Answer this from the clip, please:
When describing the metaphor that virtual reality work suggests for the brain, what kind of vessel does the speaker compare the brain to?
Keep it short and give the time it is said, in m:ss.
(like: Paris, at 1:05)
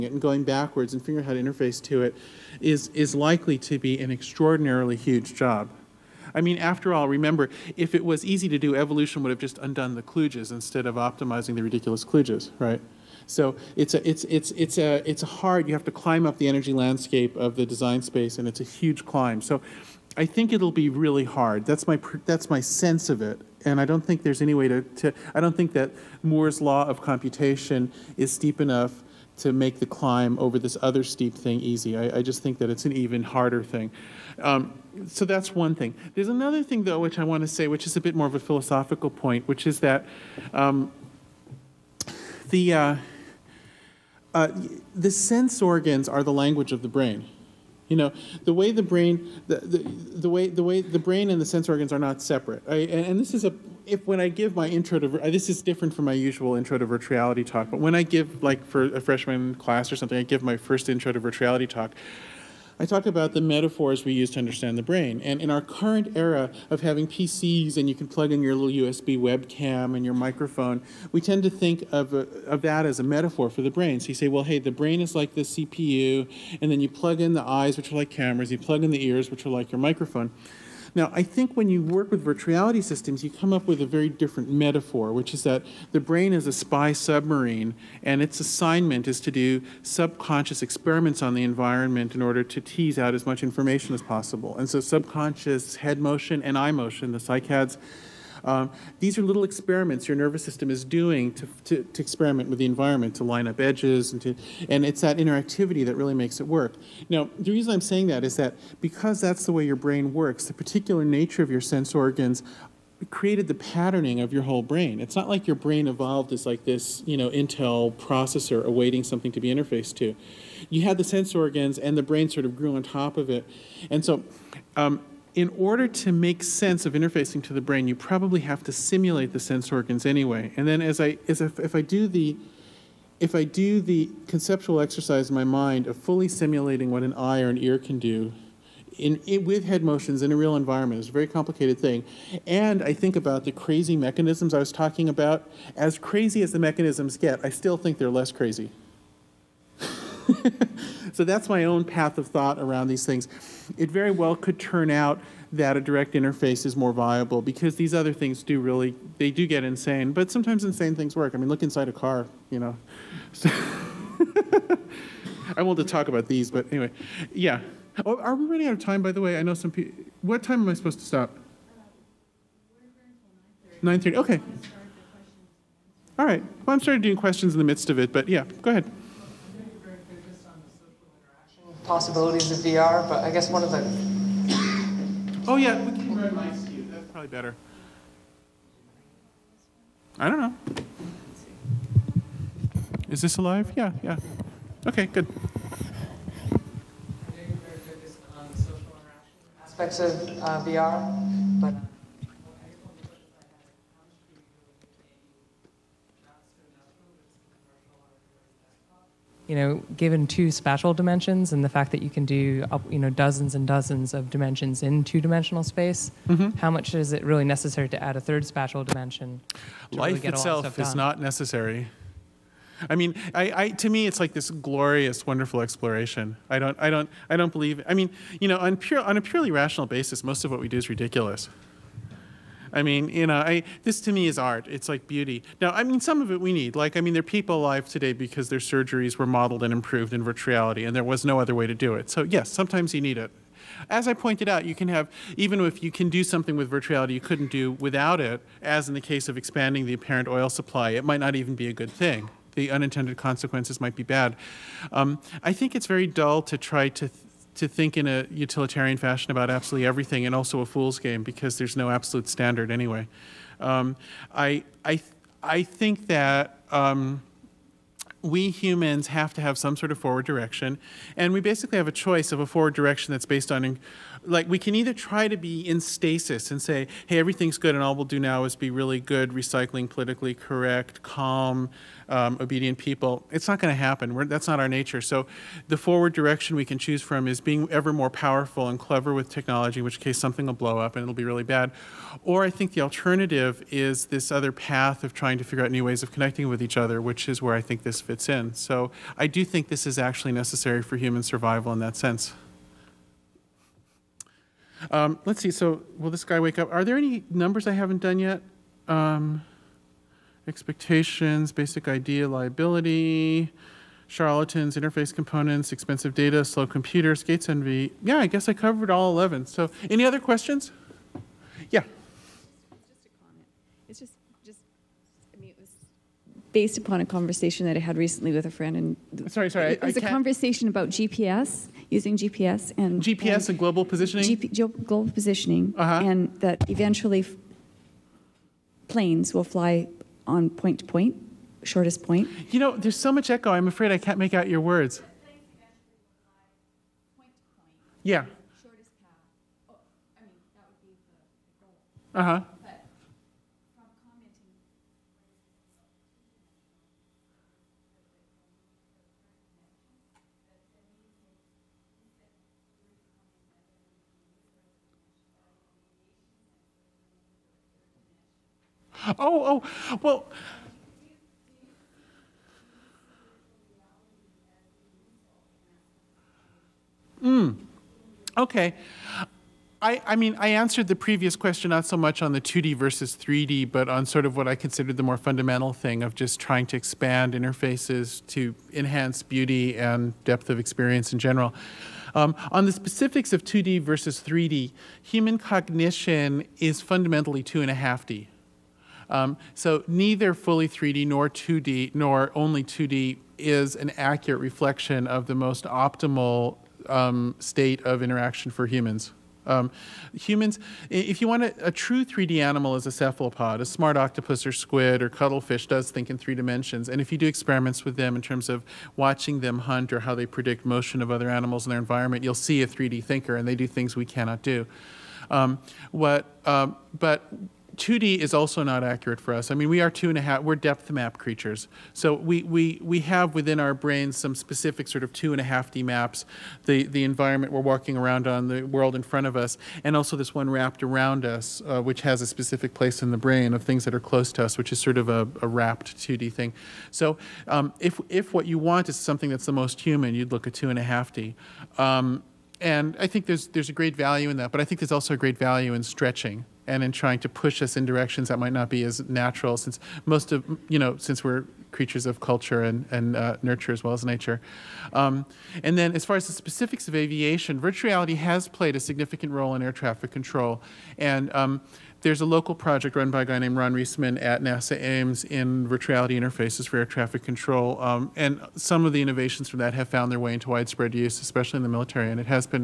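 spy submarine, at 1:26.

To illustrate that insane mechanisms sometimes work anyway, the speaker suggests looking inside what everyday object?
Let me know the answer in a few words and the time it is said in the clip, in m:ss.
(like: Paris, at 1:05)
a car, at 2:41.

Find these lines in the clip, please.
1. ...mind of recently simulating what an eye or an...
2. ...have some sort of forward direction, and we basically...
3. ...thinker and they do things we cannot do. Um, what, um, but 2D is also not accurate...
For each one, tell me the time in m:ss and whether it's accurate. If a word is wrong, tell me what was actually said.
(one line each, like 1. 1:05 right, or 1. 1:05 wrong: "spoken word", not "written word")
1. 2:15 wrong: "fully", not "recently"
2. 4:29 right
3. 7:03 right.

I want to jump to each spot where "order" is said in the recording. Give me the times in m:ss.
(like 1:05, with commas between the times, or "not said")
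1:32, 2:05.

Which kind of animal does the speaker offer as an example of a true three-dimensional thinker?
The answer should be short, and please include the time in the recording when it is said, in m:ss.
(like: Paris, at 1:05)
cephalopod, at 6:52.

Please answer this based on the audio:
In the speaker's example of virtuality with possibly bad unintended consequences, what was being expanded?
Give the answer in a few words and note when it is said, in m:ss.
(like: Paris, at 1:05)
apparent oil supply, at 4:09.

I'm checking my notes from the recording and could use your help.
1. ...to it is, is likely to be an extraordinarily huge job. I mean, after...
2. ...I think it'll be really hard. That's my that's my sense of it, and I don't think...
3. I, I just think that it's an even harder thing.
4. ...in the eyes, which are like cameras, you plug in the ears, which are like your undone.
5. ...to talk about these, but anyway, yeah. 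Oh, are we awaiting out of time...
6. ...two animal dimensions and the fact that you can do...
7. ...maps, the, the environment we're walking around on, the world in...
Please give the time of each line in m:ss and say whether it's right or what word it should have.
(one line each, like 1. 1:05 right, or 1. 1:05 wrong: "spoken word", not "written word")
1. 0:01 right
2. 0:20 right
3. 0:31 right
4. 1:17 wrong: "microphone", not "undone"
5. 2:45 wrong: "running", not "awaiting"
6. 3:30 wrong: "spatial", not "animal"
7. 7:15 right.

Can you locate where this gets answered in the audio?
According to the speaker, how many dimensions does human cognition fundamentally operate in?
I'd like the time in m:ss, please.
6:37.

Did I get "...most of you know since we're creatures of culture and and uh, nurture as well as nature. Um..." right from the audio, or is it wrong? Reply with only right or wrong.
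right.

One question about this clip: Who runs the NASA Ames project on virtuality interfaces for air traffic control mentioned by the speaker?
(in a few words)
Ron Reisman.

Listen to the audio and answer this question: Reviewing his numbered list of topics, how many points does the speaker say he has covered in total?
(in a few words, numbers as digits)
11.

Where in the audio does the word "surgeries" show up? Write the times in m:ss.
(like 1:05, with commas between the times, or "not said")
3:58.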